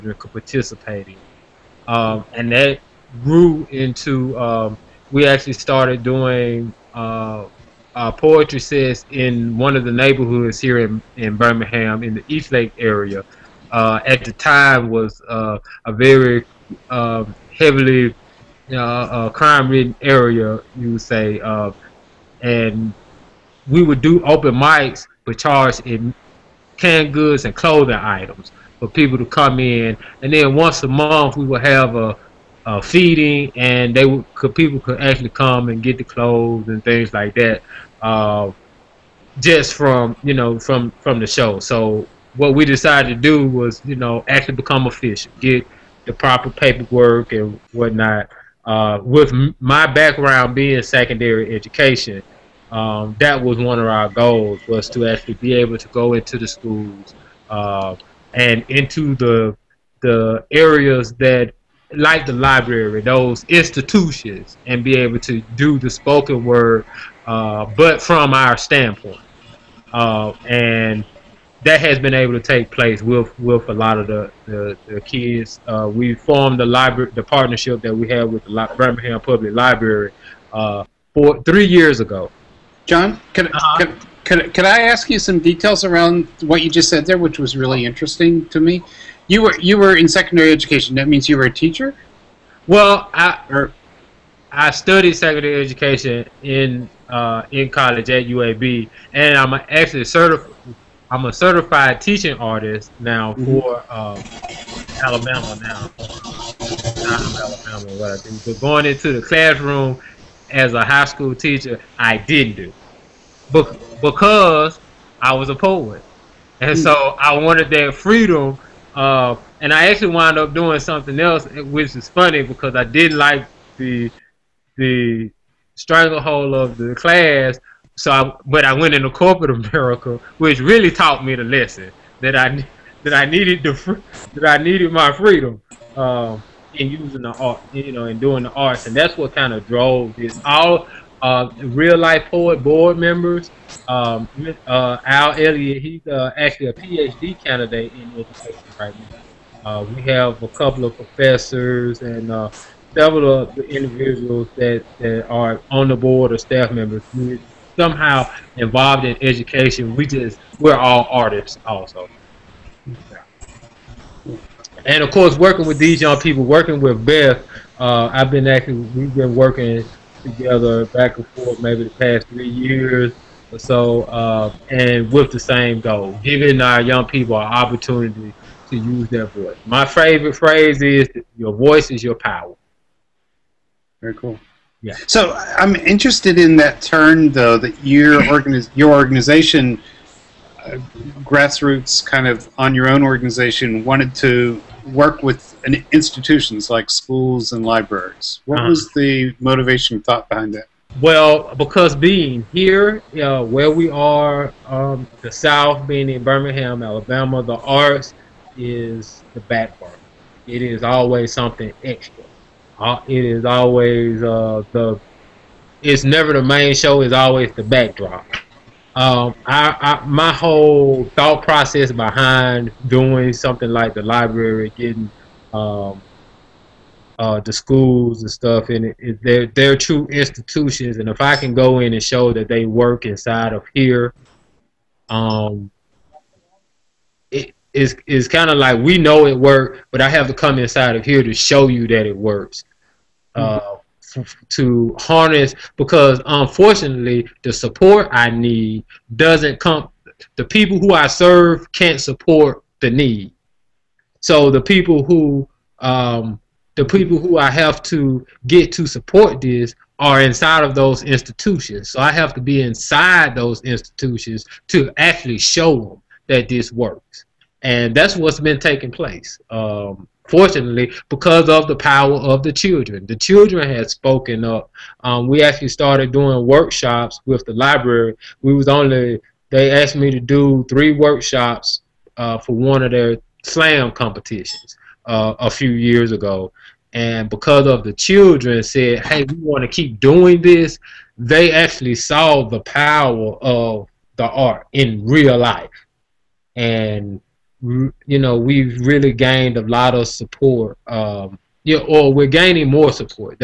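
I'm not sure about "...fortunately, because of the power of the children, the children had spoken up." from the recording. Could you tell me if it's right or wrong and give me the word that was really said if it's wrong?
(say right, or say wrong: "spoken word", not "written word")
right.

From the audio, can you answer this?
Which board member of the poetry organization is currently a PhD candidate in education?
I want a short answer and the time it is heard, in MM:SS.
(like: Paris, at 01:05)
Al Elliott, at 02:25.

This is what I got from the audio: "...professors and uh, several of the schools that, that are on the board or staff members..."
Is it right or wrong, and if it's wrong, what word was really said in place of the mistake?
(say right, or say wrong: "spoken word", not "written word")
wrong: "individuals", not "schools".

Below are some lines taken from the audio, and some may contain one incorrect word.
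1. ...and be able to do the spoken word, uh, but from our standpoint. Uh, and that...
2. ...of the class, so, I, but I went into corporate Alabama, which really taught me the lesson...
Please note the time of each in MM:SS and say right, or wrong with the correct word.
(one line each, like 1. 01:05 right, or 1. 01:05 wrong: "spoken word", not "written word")
1. 01:04 right
2. 02:06 wrong: "America", not "Alabama".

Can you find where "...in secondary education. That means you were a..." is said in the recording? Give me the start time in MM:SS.
01:29.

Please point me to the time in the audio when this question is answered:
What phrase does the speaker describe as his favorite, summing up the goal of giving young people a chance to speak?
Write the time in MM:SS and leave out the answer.
03:01.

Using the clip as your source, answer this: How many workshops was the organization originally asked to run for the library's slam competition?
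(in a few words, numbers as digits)
3.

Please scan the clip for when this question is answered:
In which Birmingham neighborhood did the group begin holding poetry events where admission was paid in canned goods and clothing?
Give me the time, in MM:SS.
00:12.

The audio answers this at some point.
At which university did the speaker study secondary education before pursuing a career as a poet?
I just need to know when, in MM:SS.
01:38.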